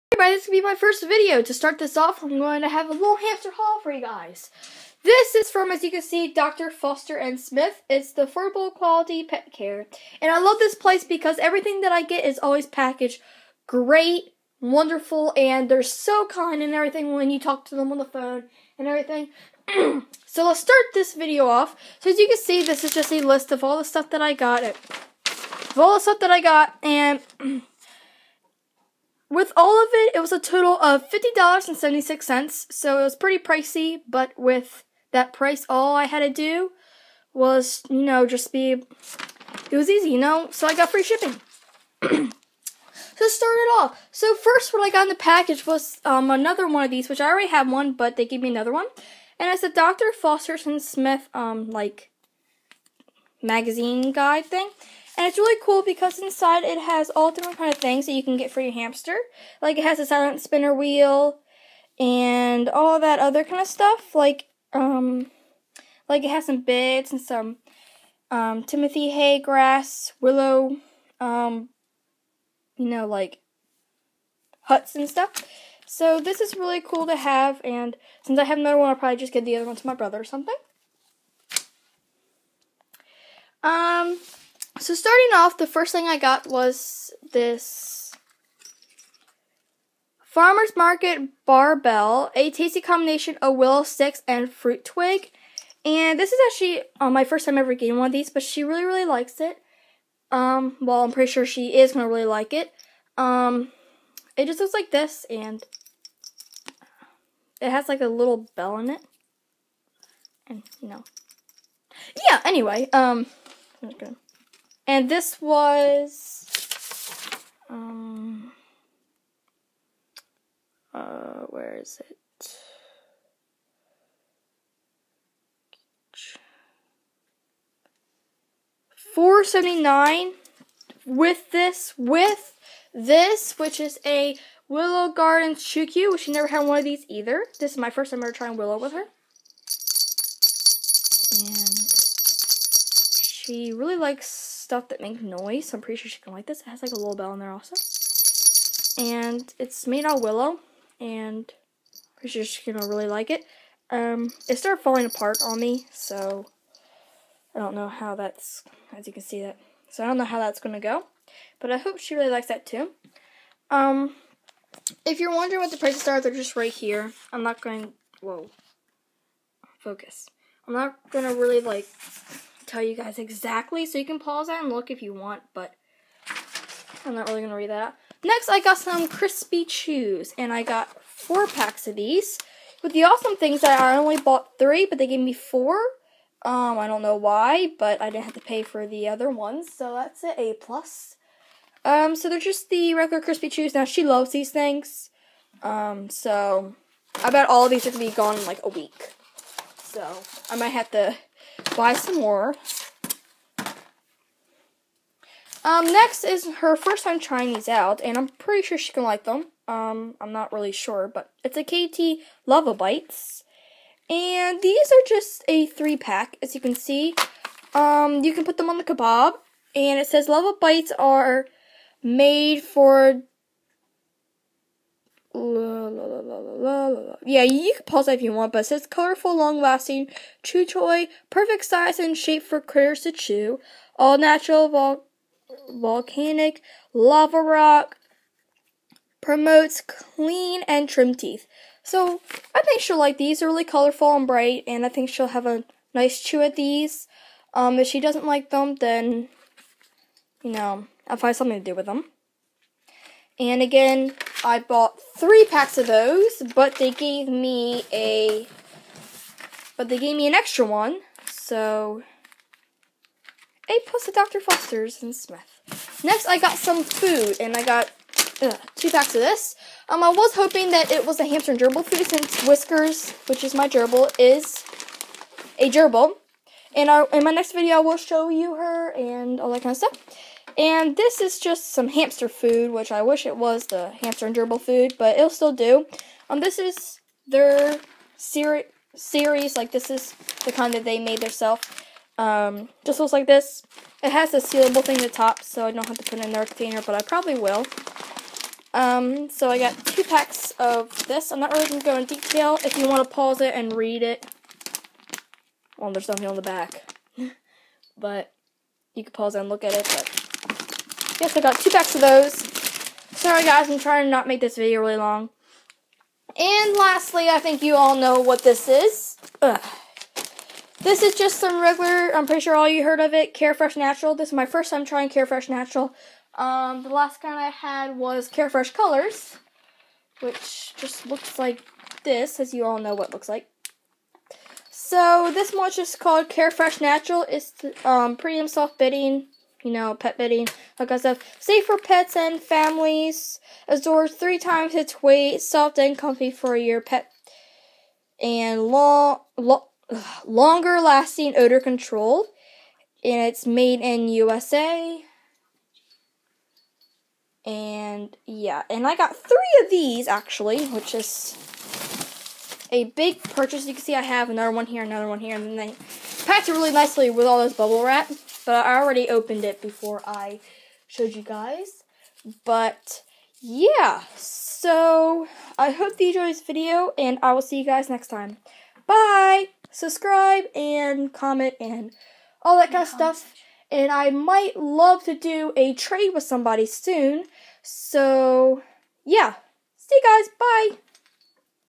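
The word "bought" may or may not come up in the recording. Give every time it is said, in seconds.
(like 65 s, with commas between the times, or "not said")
184 s, 254 s.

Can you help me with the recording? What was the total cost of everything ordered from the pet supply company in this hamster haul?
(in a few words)
$50.76.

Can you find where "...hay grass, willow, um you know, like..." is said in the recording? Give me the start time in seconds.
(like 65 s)
69 s.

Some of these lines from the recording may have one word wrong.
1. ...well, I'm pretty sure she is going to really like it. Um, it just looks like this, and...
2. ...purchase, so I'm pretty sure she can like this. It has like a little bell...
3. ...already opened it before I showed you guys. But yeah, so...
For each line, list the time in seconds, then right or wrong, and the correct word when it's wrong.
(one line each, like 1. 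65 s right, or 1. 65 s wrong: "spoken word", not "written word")
1. 100 s right
2. 145 s wrong: "noise", not "purchase"
3. 368 s right.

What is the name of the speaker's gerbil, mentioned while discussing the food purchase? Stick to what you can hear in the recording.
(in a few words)
Whiskers.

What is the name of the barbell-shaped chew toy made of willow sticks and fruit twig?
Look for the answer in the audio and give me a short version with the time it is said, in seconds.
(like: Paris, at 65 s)
Farmer's Market Barbell, at 90 s.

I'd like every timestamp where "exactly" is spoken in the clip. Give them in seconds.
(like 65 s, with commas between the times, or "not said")
173 s.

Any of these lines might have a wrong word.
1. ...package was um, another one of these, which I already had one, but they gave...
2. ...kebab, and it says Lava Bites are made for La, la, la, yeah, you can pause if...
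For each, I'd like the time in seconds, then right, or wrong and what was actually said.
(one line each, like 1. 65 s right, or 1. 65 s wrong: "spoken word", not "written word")
1. 45 s right
2. 218 s right.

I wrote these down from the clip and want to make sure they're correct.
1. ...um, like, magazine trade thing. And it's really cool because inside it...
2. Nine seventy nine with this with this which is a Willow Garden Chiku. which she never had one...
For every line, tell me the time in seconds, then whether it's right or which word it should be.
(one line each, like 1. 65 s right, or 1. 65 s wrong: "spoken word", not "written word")
1. 51 s wrong: "guide", not "trade"
2. 129 s wrong: "Four", not "Nine".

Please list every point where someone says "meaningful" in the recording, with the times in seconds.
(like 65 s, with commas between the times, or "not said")
not said.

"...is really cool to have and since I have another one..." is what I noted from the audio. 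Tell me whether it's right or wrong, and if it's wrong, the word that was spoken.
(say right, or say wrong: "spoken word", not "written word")
right.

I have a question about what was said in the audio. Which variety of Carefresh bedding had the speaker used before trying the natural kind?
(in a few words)
Carefresh Colors.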